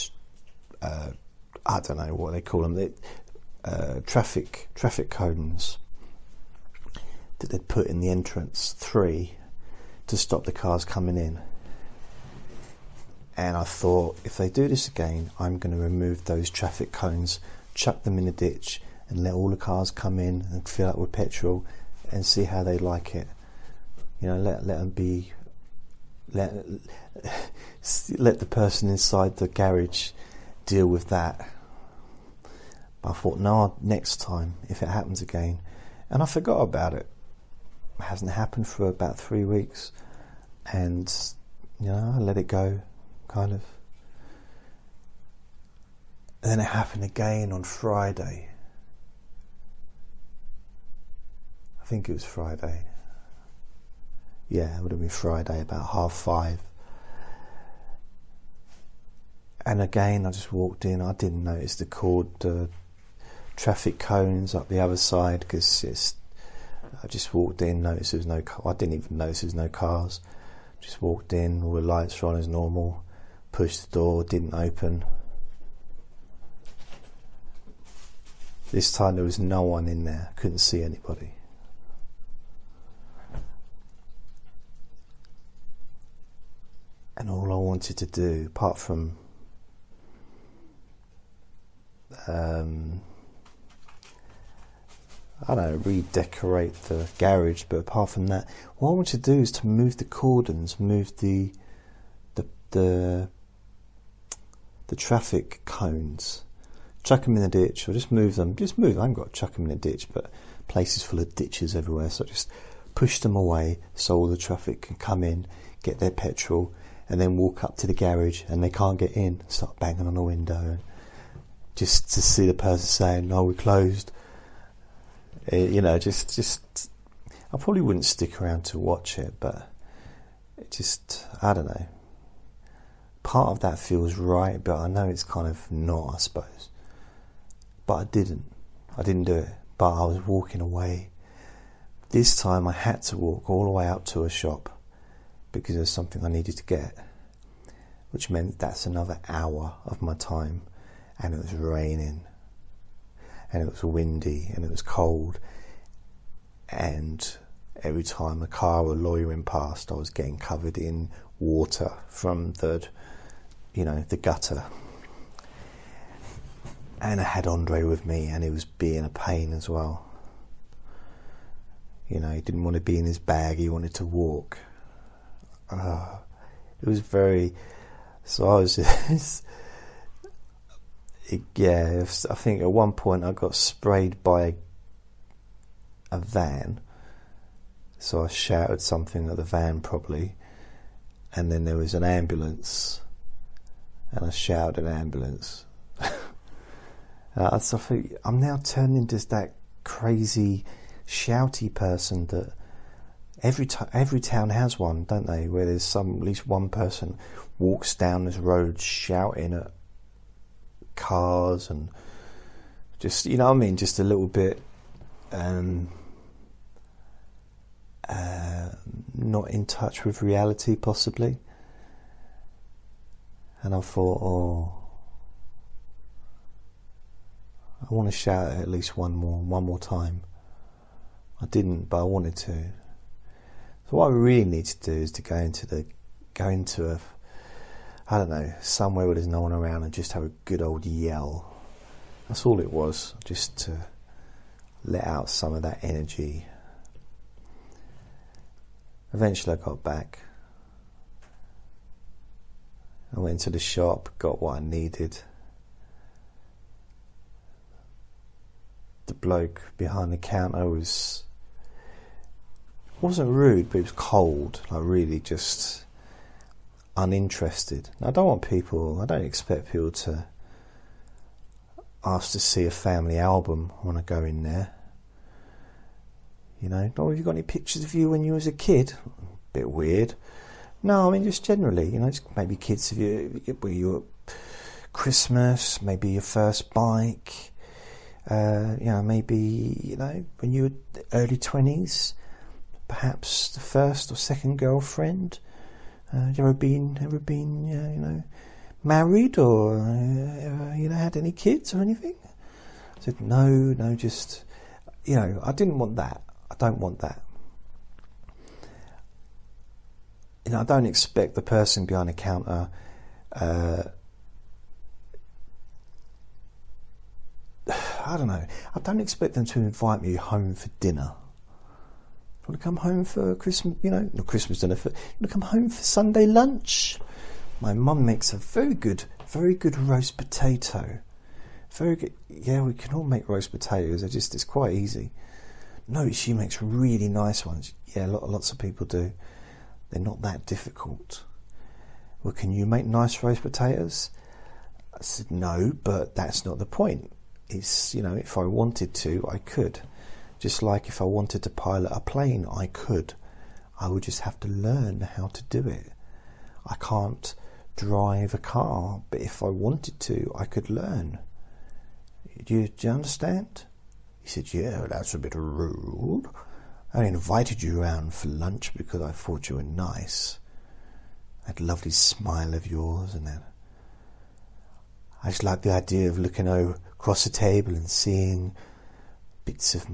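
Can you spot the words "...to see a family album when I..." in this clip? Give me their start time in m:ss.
4:32.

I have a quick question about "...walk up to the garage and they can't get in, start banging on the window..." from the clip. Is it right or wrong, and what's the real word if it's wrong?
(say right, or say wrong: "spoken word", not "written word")
right.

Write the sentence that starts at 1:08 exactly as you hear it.
I didn't even notice there was no cars.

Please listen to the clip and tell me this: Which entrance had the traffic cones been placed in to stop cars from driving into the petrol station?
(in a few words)
Entrance three.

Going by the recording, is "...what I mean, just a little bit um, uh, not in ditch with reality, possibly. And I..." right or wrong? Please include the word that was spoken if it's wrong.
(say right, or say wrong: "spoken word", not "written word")
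wrong: "touch", not "ditch".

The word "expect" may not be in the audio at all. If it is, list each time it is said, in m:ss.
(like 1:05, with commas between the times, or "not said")
4:29, 5:10, 5:19.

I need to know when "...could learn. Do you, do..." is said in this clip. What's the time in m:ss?
6:00.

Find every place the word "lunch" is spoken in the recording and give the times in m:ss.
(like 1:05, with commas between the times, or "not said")
5:26, 6:08.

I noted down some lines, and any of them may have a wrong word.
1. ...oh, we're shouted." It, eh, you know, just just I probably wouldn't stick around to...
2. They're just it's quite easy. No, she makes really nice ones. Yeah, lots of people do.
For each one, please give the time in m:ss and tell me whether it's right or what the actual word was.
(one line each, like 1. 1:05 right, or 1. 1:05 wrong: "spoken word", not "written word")
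1. 2:03 wrong: "closed", not "shouted"
2. 5:34 right.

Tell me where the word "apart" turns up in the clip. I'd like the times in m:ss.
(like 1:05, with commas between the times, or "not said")
1:28, 1:37.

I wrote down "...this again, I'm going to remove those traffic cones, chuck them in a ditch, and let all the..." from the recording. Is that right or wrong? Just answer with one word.
right.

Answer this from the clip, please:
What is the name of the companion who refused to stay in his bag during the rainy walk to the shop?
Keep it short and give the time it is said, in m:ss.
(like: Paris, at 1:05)
Andre, at 2:47.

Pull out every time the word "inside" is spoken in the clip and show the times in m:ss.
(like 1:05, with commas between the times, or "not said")
0:28.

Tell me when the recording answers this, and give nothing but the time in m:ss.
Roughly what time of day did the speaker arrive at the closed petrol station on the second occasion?
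0:55.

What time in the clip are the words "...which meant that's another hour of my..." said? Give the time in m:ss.
2:28.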